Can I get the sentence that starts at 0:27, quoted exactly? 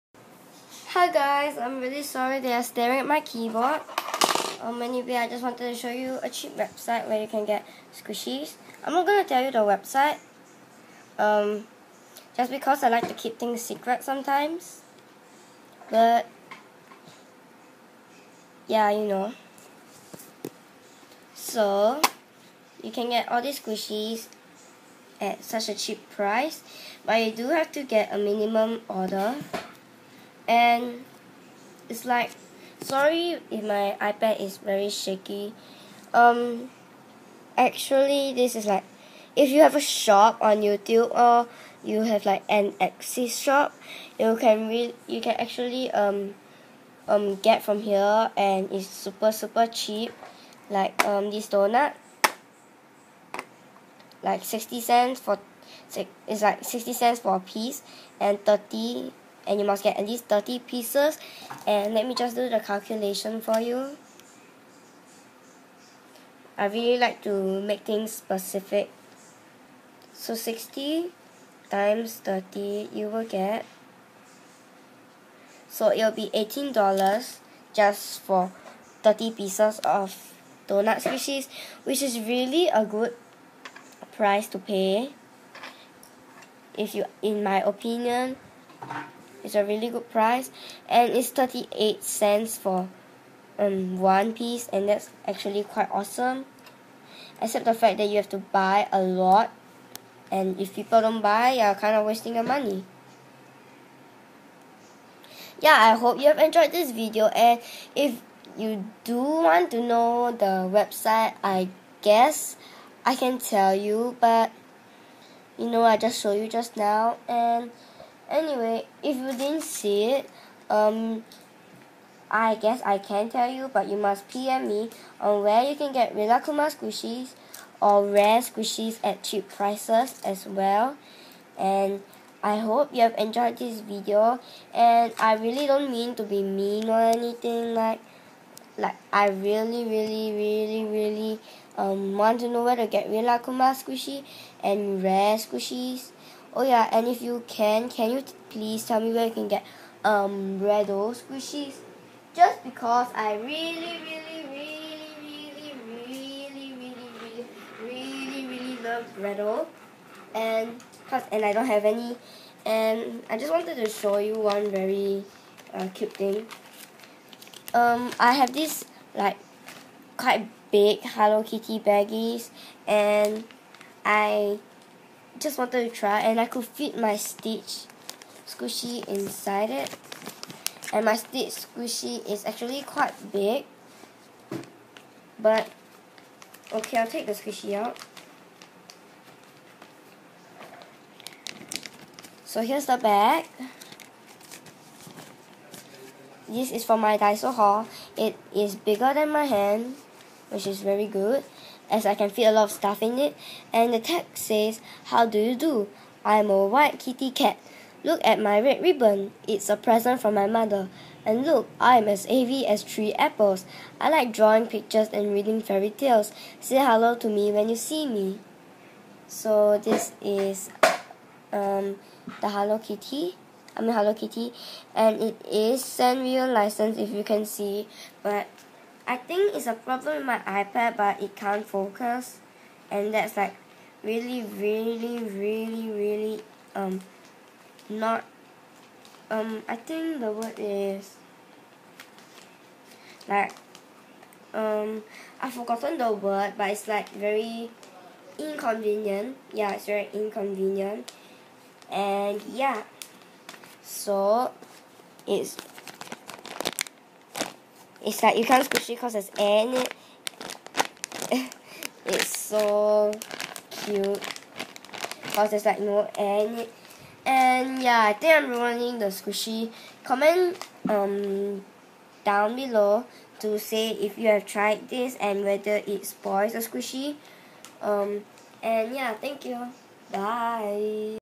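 But you do have to get a minimum order and it's like sorry if my iPad is very shaky.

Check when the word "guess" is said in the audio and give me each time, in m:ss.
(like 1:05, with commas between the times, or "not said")
1:52, 2:02.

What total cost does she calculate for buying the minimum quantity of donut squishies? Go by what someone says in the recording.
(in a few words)
$18.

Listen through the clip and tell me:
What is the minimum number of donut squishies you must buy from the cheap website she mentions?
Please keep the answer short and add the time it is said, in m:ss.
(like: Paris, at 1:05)
30, at 0:59.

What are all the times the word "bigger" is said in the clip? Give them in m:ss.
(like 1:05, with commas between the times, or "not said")
3:18.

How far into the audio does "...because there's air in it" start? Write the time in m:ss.
4:18.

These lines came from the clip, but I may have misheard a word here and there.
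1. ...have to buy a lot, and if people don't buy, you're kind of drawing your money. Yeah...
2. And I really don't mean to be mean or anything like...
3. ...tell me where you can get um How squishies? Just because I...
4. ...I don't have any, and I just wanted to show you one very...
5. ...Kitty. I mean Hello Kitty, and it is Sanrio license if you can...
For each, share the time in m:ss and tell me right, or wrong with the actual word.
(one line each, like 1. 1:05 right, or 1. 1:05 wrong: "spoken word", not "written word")
1. 1:38 wrong: "wasting", not "drawing"
2. 2:14 right
3. 2:28 wrong: "Redo", not "How"
4. 2:41 right
5. 3:42 right.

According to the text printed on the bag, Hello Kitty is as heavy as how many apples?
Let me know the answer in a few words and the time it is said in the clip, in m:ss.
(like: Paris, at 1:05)
3, at 3:32.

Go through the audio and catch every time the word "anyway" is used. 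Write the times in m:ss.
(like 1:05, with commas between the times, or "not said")
0:04, 1:58.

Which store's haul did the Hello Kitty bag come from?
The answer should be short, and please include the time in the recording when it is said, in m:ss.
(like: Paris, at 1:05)
Daiso, at 3:17.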